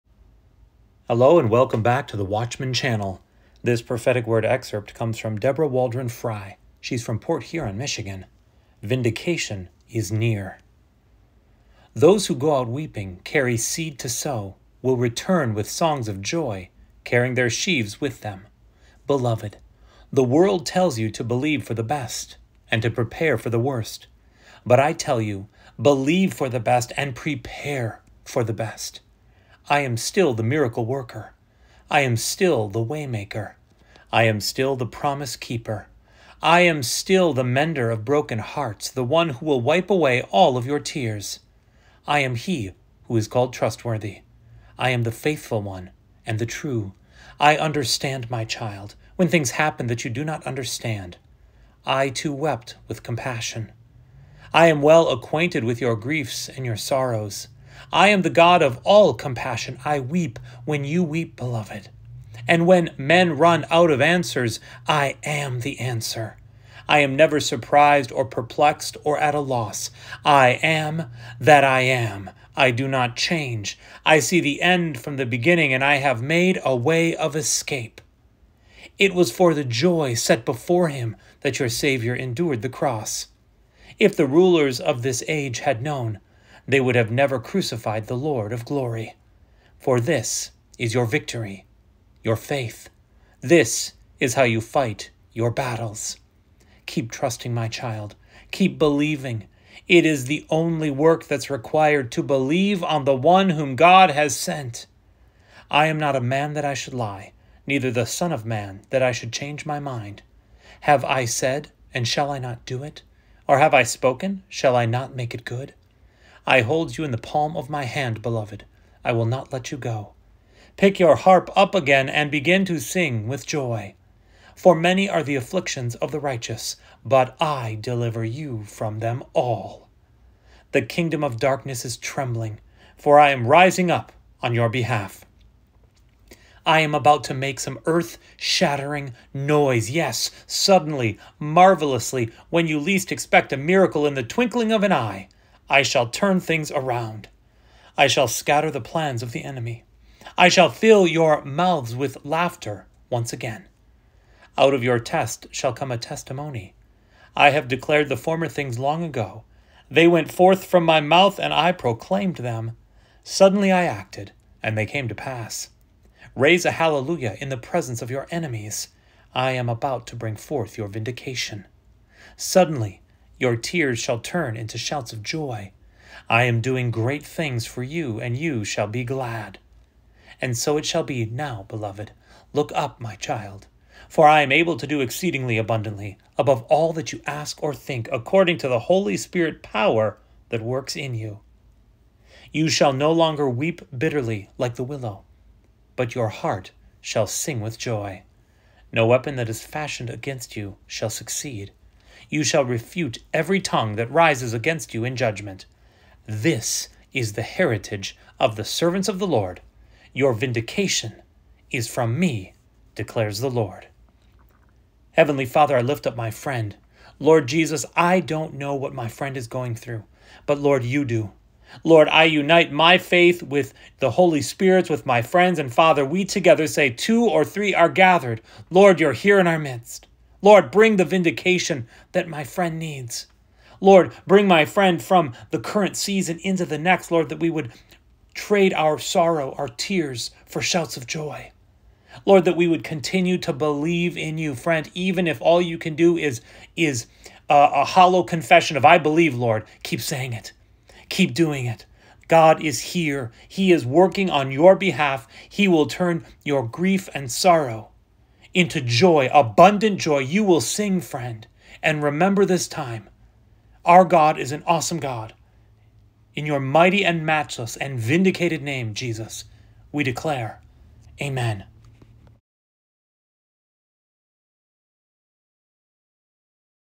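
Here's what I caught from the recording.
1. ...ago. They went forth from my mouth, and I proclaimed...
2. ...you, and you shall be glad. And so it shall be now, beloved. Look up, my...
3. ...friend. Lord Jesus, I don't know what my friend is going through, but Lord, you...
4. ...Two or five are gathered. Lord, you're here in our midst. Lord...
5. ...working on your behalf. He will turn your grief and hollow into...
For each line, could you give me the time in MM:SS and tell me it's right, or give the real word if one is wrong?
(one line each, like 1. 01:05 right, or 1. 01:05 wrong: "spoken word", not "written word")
1. 02:39 right
2. 02:57 right
3. 03:36 right
4. 03:46 wrong: "three", not "five"
5. 04:13 wrong: "sorrow", not "hollow".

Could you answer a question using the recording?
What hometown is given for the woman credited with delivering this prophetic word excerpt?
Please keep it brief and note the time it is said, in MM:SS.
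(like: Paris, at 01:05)
Port Huron, Michigan, at 00:07.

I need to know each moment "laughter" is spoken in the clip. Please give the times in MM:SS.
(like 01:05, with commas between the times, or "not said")
02:32.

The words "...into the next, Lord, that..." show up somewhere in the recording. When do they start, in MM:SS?
03:56.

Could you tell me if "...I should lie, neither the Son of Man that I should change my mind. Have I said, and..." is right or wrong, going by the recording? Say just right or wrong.
right.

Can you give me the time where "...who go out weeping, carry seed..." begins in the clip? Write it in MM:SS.
00:12.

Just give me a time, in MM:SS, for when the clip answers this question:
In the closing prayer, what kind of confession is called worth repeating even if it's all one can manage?
04:07.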